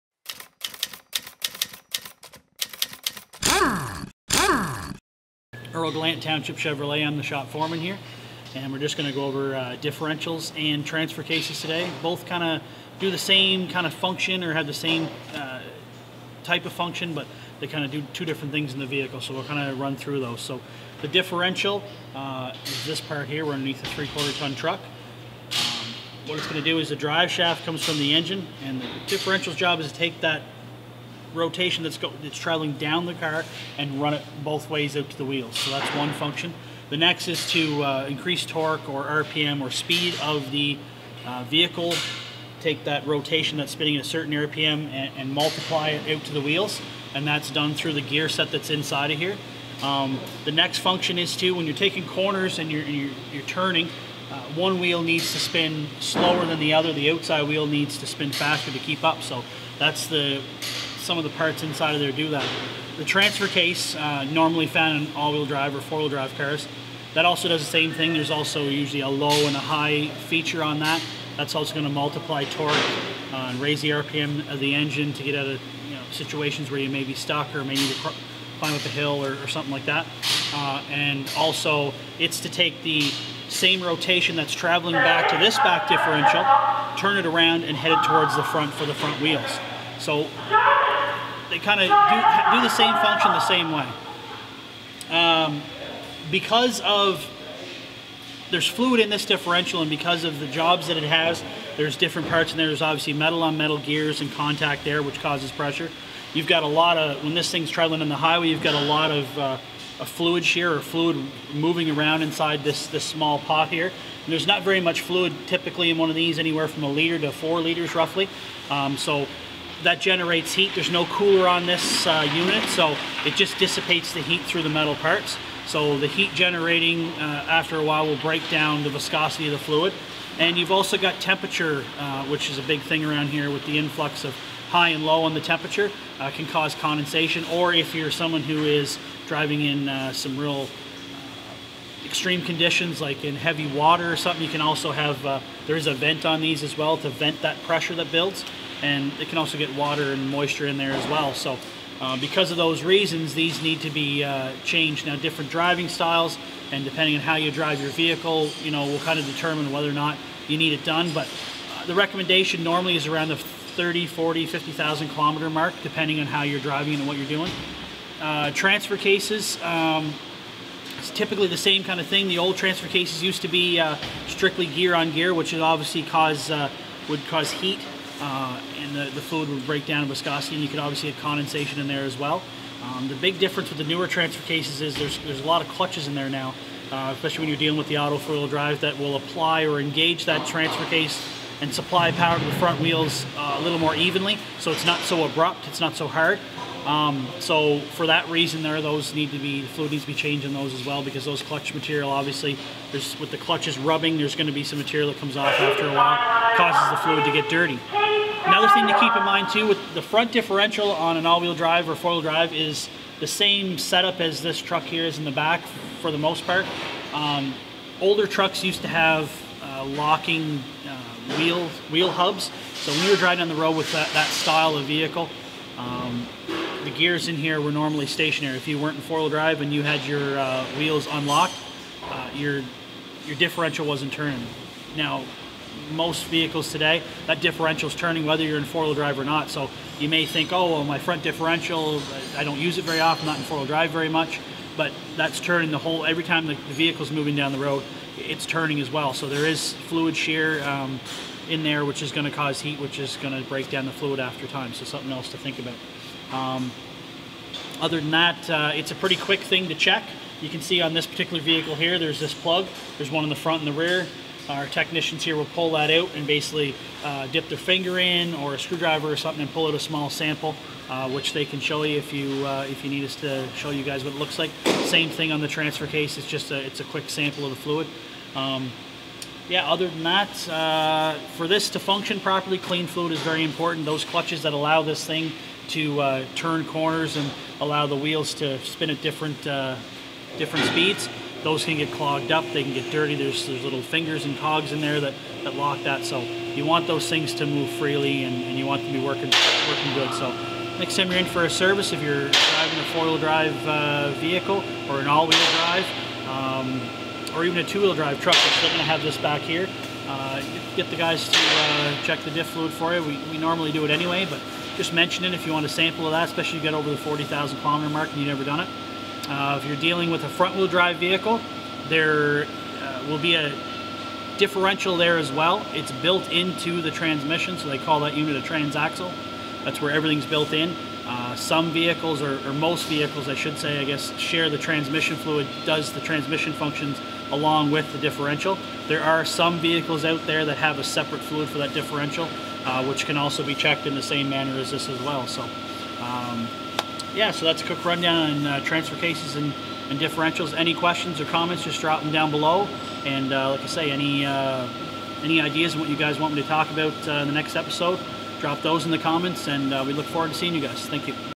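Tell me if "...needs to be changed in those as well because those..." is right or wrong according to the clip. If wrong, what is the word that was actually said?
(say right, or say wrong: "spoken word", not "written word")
right.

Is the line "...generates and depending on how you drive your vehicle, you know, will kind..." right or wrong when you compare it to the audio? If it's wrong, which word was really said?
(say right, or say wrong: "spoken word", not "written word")
wrong: "styles", not "generates".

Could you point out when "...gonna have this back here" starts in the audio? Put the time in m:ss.
5:08.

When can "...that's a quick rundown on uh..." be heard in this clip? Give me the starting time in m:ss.
5:47.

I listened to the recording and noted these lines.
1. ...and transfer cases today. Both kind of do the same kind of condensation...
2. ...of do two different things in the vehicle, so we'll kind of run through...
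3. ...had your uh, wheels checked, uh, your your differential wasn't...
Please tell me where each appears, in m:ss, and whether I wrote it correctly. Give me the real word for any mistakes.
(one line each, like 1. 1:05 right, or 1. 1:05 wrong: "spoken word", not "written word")
1. 0:10 wrong: "function", not "condensation"
2. 0:17 right
3. 3:49 wrong: "unlocked", not "checked".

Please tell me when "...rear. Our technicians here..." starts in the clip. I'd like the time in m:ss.
4:23.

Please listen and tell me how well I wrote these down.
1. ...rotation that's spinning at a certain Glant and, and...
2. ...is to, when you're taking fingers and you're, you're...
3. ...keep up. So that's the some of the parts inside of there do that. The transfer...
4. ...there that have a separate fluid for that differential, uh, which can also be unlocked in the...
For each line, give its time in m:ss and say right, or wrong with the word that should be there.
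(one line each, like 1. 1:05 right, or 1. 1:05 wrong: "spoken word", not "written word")
1. 0:43 wrong: "RPM", not "Glant"
2. 0:51 wrong: "corners", not "fingers"
3. 0:58 right
4. 5:40 wrong: "checked", not "unlocked".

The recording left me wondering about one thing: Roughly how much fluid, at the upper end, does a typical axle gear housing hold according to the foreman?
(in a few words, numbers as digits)
4 liters.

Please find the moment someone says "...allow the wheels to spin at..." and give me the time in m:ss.
4:47.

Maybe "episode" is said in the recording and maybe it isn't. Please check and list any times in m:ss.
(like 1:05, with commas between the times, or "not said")
5:57.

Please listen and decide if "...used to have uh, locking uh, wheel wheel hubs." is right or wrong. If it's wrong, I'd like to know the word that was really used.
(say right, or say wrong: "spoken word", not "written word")
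right.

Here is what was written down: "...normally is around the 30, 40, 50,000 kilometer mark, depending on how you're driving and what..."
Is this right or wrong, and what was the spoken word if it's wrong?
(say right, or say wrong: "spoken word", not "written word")
right.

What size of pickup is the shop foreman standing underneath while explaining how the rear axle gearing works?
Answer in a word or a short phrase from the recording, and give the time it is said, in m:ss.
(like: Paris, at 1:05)
three-quarter ton truck, at 0:23.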